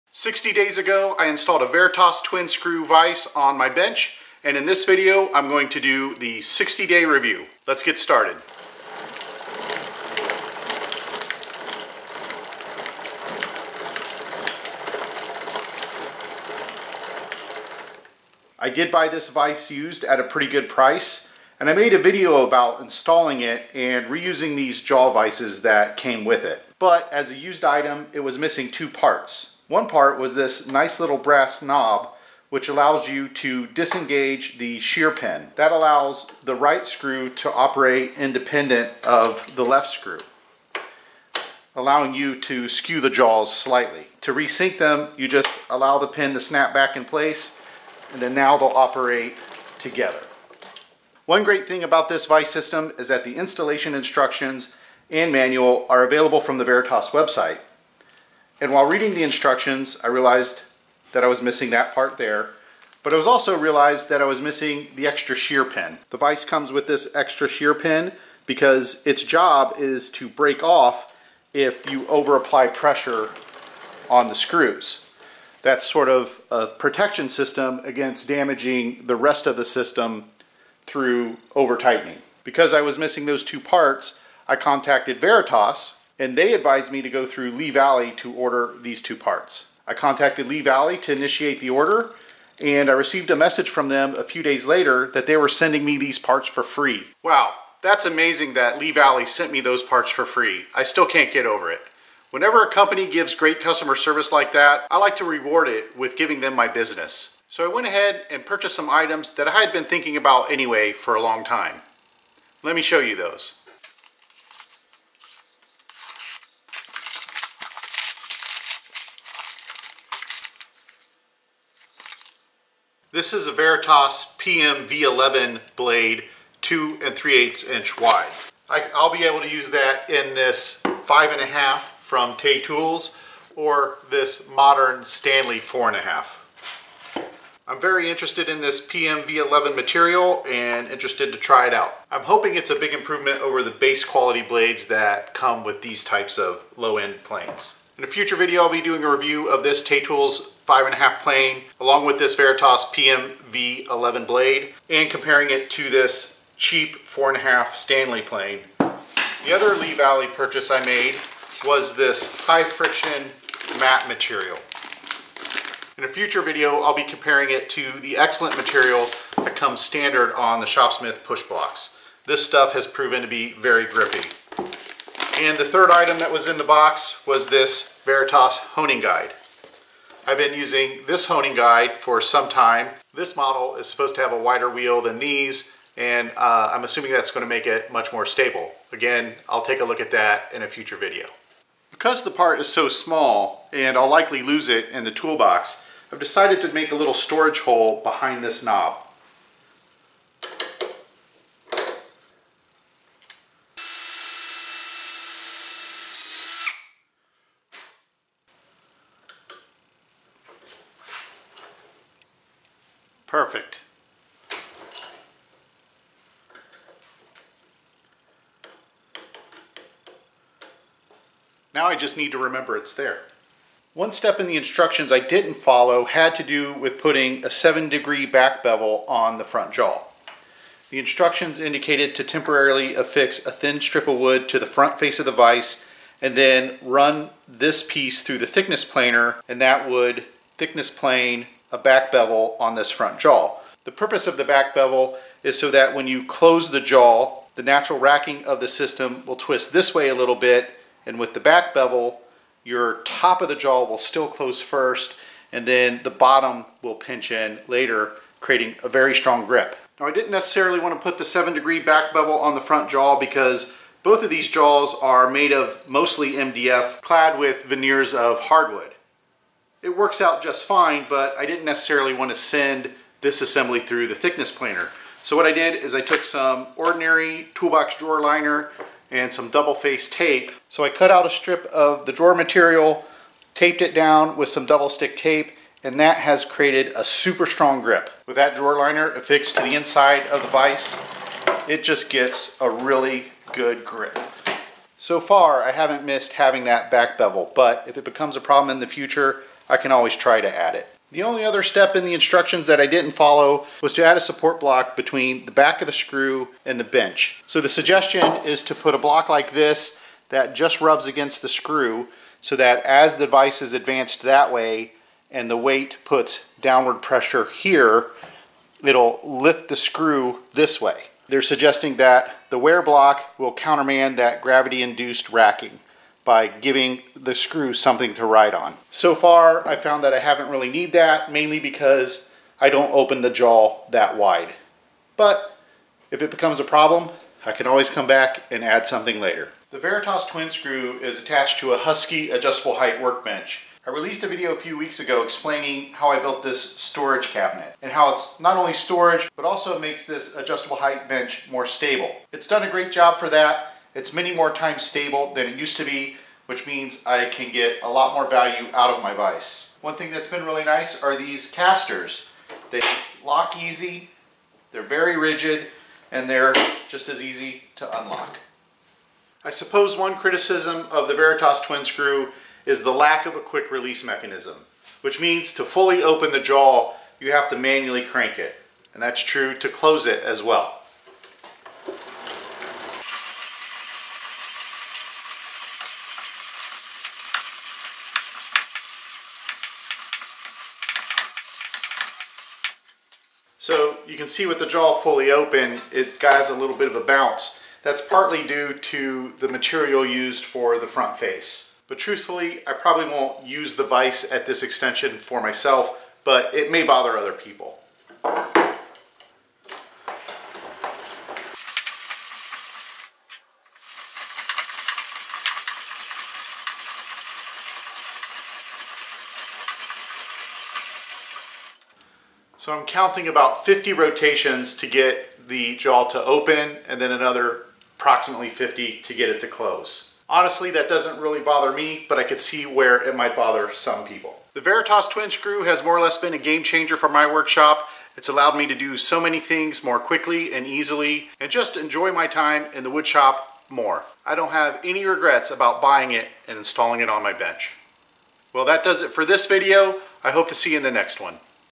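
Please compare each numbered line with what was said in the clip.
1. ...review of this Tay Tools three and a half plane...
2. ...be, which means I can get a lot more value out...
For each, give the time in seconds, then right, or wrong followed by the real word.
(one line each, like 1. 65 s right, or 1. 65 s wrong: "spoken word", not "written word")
1. 149 s wrong: "five", not "three"
2. 355 s right.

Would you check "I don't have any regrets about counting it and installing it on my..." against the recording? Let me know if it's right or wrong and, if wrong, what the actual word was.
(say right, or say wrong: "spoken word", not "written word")
wrong: "buying", not "counting".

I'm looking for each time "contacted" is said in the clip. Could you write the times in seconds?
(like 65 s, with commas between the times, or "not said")
84 s, 89 s.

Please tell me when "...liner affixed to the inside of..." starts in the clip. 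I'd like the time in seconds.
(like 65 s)
288 s.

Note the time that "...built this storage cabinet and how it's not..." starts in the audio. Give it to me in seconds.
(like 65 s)
346 s.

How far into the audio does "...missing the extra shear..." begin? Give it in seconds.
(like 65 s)
64 s.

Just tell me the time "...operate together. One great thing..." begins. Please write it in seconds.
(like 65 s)
48 s.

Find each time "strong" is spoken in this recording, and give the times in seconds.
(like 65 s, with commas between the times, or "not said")
259 s, 287 s.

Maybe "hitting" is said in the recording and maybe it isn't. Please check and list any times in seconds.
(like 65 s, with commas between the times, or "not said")
not said.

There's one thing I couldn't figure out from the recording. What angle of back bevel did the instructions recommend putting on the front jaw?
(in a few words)
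7 degrees.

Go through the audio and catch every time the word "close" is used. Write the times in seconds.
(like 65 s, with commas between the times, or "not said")
246 s, 254 s, 379 s, 429 s.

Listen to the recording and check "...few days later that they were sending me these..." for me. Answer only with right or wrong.
right.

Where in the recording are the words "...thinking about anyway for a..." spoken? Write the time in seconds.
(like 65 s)
109 s.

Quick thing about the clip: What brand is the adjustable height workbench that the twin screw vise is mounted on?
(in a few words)
Husky.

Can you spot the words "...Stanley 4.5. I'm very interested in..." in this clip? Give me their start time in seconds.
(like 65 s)
135 s.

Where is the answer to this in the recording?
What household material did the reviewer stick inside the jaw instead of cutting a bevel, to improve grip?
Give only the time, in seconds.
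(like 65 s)
277 s.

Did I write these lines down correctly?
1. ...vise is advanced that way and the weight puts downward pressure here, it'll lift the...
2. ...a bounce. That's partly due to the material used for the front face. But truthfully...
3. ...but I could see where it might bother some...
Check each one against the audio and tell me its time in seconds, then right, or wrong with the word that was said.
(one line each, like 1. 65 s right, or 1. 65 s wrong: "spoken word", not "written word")
1. 313 s right
2. 396 s right
3. 432 s right.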